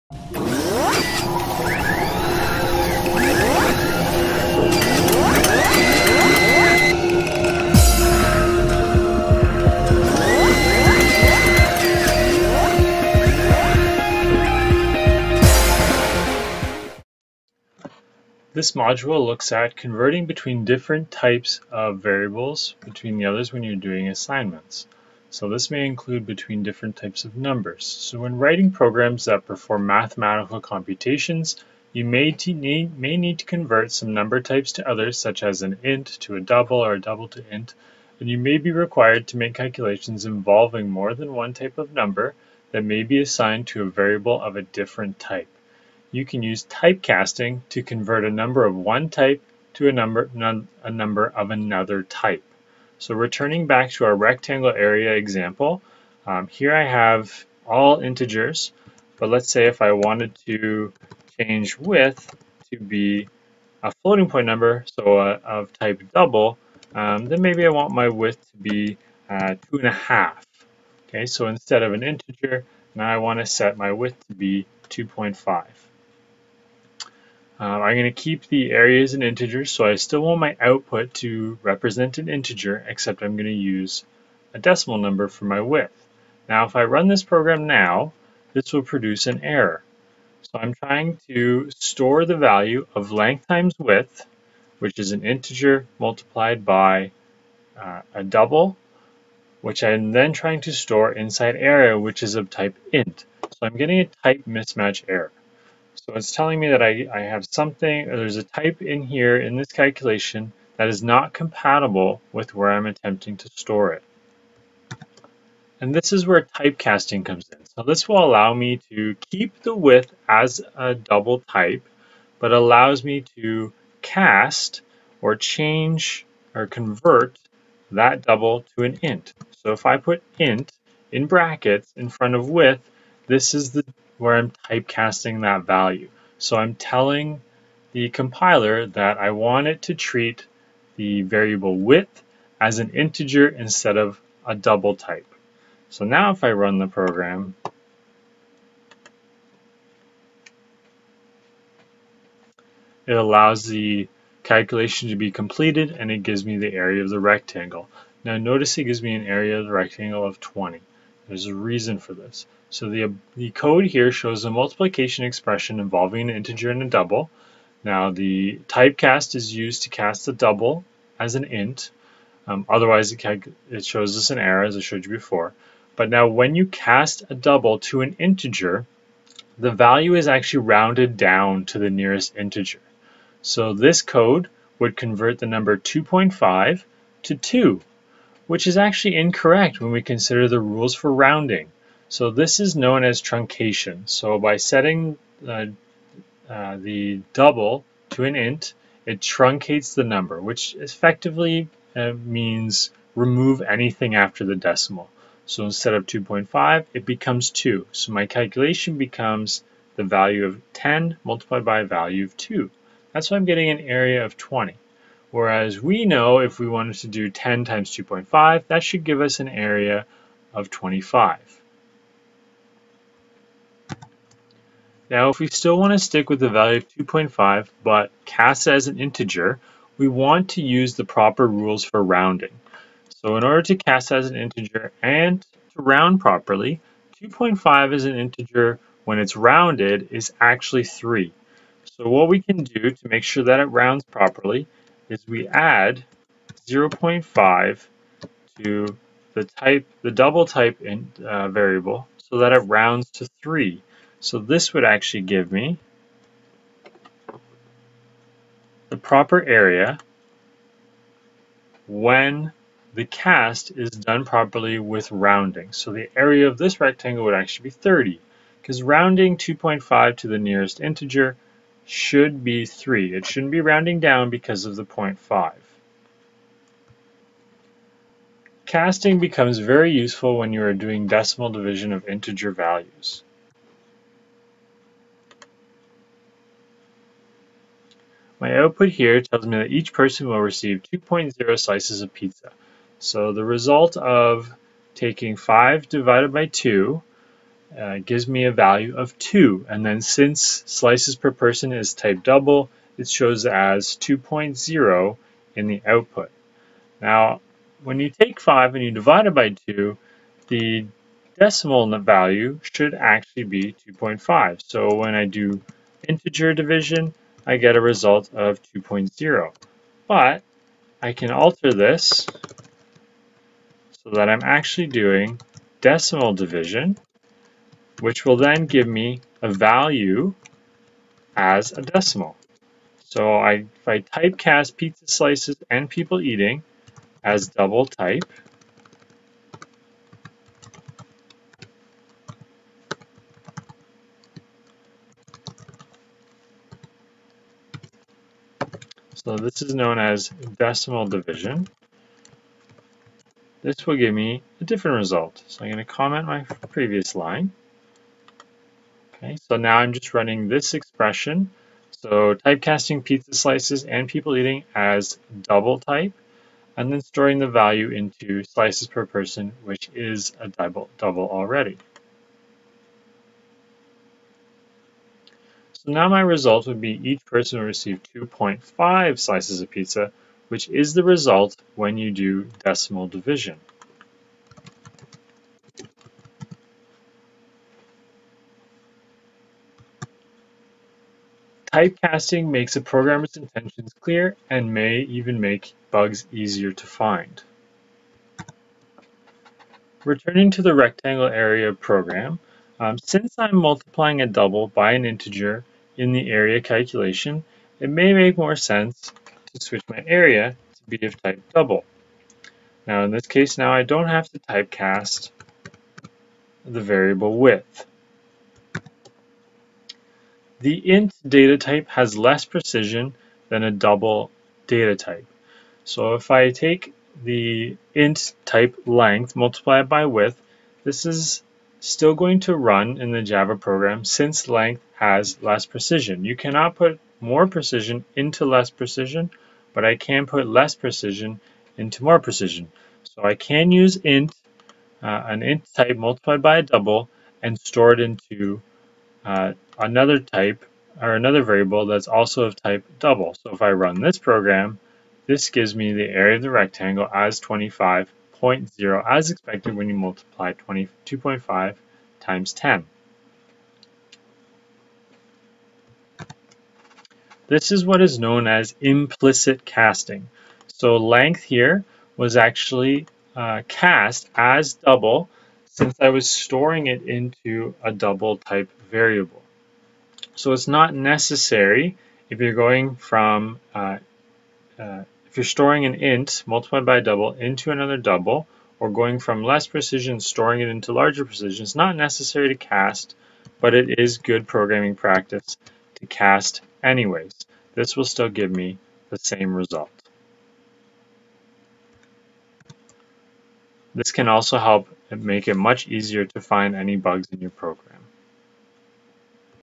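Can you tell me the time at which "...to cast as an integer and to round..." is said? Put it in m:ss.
3:53.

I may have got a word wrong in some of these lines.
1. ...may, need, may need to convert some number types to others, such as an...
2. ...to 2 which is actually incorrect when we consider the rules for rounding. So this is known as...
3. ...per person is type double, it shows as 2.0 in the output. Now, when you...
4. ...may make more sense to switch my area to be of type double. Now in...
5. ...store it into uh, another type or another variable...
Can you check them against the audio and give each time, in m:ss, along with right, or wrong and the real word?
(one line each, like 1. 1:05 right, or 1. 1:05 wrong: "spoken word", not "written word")
1. 0:32 right
2. 3:07 right
3. 5:01 right
4. 6:47 right
5. 7:27 right.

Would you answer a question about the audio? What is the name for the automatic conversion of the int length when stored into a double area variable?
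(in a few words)
implicit casting.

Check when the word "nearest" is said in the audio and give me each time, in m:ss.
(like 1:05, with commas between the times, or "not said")
3:01, 4:30.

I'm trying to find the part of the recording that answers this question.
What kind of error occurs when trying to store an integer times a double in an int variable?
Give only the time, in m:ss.
1:44.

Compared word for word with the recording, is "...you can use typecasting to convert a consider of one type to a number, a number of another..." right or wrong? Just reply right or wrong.
wrong.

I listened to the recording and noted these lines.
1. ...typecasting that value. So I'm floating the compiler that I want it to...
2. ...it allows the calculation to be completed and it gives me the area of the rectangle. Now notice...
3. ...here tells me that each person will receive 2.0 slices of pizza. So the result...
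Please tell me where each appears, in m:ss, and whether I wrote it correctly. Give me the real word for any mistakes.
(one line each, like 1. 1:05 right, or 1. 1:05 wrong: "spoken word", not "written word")
1. 2:14 wrong: "telling", not "floating"
2. 2:33 right
3. 4:48 right.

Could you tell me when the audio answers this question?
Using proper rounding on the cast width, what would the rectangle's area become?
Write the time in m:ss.
4:27.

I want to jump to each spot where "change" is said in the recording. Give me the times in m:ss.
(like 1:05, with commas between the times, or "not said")
1:01, 2:05.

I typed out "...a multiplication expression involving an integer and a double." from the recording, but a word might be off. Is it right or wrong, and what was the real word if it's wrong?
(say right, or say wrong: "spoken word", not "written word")
right.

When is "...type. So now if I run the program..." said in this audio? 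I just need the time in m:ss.
2:24.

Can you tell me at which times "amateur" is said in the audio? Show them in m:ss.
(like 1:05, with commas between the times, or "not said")
not said.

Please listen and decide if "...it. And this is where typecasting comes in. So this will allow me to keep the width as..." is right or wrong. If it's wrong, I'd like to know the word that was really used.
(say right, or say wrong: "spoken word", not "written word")
right.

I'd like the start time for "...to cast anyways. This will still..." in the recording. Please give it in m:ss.
8:16.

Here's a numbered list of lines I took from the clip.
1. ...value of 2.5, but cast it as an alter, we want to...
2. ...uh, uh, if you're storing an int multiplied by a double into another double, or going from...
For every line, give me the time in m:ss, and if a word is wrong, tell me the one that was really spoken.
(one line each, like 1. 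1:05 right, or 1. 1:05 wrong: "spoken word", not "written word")
1. 3:46 wrong: "integer", not "alter"
2. 8:03 right.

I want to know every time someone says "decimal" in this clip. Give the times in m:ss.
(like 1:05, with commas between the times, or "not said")
1:24, 3:24, 4:41, 5:11, 5:25, 5:31, 5:50, 6:22.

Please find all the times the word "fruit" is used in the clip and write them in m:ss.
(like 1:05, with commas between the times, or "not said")
not said.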